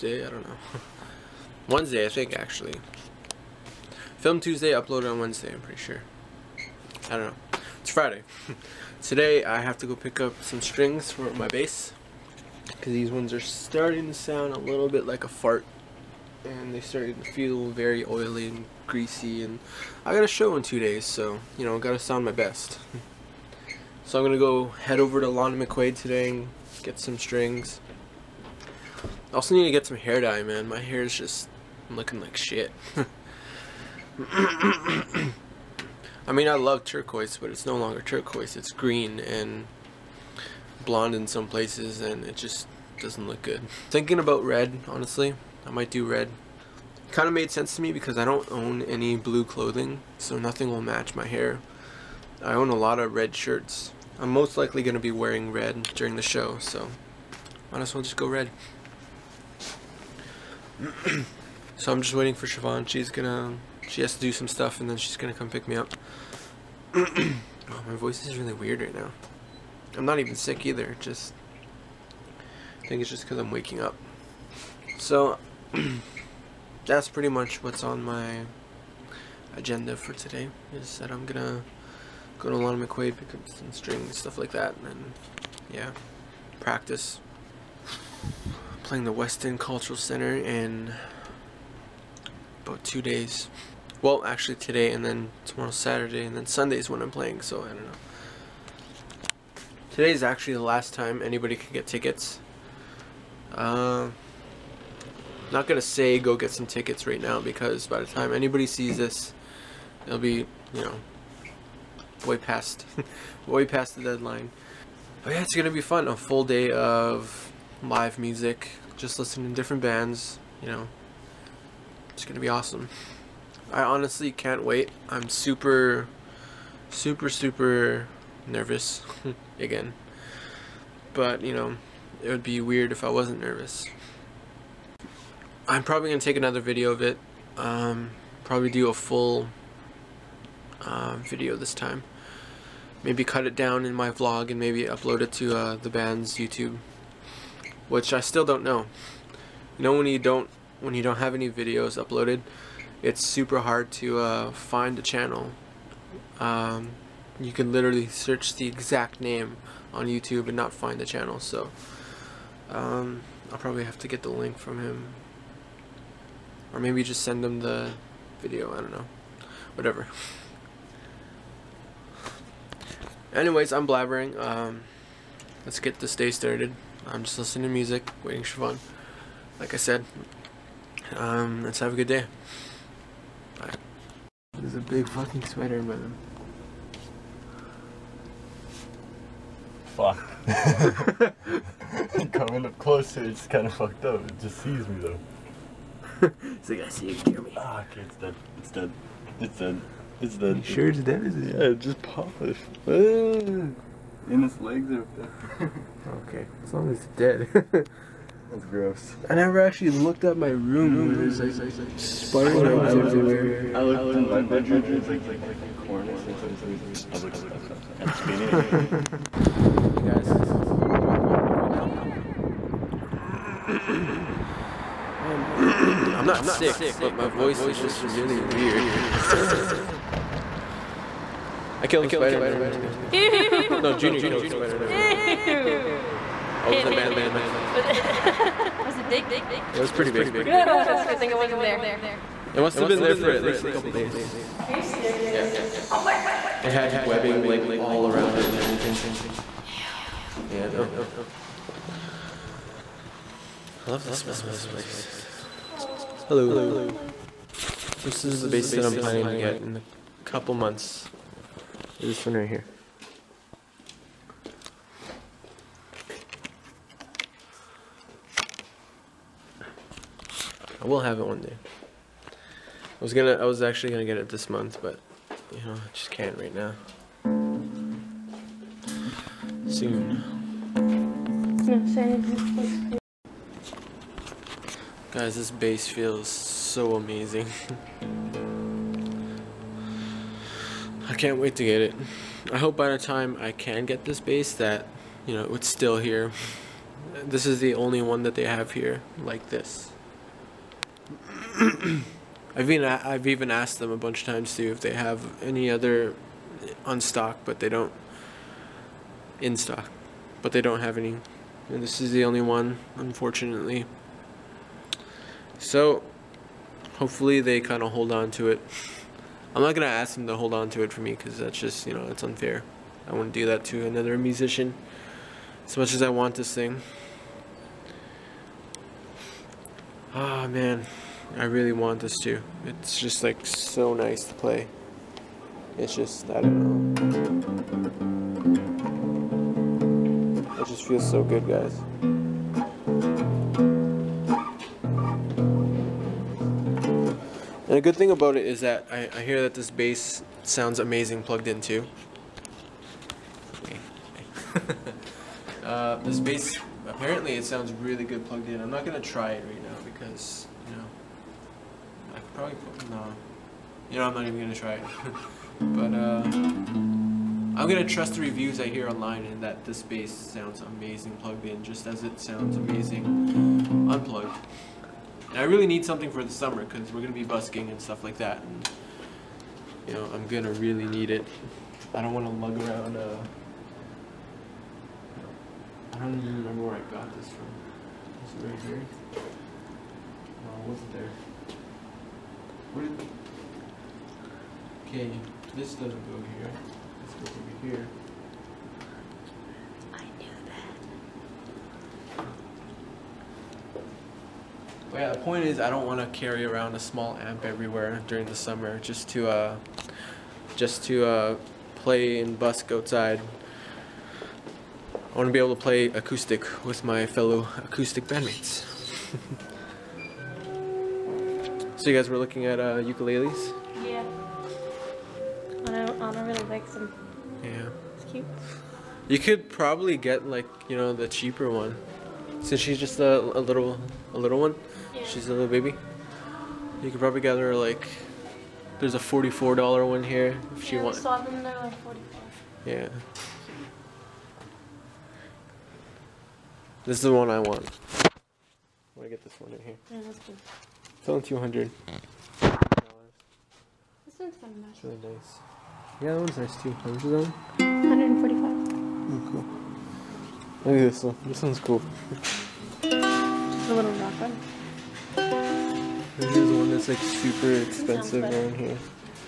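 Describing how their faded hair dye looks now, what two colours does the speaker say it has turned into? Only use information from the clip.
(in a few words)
green and blonde.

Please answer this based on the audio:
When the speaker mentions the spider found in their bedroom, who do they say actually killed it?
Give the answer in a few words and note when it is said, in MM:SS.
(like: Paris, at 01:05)
Junior, at 03:53.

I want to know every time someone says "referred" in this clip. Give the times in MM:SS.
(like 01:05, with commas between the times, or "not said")
not said.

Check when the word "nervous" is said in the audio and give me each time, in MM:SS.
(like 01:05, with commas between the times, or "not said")
02:08, 02:13.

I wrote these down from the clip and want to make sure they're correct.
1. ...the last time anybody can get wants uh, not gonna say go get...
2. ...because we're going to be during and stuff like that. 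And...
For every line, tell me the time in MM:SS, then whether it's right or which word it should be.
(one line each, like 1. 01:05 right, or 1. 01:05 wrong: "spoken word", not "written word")
1. 01:40 wrong: "tickets", not "wants"
2. 06:16 wrong: "busking", not "during".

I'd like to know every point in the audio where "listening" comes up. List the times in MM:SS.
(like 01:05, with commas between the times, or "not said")
01:59, 02:57.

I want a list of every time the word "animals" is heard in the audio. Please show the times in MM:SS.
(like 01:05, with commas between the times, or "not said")
not said.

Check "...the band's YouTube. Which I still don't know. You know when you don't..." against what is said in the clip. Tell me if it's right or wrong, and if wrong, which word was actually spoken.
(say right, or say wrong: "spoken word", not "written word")
right.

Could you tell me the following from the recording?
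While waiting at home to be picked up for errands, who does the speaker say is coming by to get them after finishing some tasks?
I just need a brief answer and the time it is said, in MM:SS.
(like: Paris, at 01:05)
Siobhan, at 01:02.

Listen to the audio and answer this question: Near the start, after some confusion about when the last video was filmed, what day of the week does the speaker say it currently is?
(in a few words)
Friday.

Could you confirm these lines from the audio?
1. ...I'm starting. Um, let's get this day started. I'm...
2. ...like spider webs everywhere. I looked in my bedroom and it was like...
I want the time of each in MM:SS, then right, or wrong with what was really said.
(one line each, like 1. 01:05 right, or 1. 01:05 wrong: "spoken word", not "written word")
1. 02:53 wrong: "blabbering", not "starting"
2. 03:31 right.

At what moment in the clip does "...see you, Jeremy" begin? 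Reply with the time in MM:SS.
03:16.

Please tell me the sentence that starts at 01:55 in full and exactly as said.
But yeah, it's gonna be fun.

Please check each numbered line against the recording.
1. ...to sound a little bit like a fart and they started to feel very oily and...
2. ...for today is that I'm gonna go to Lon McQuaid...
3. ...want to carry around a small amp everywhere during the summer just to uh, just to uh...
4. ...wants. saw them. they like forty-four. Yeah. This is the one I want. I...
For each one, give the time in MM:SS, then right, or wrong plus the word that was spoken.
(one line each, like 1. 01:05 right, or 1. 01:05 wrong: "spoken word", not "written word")
1. 00:14 right
2. 01:19 right
3. 06:45 right
4. 07:20 right.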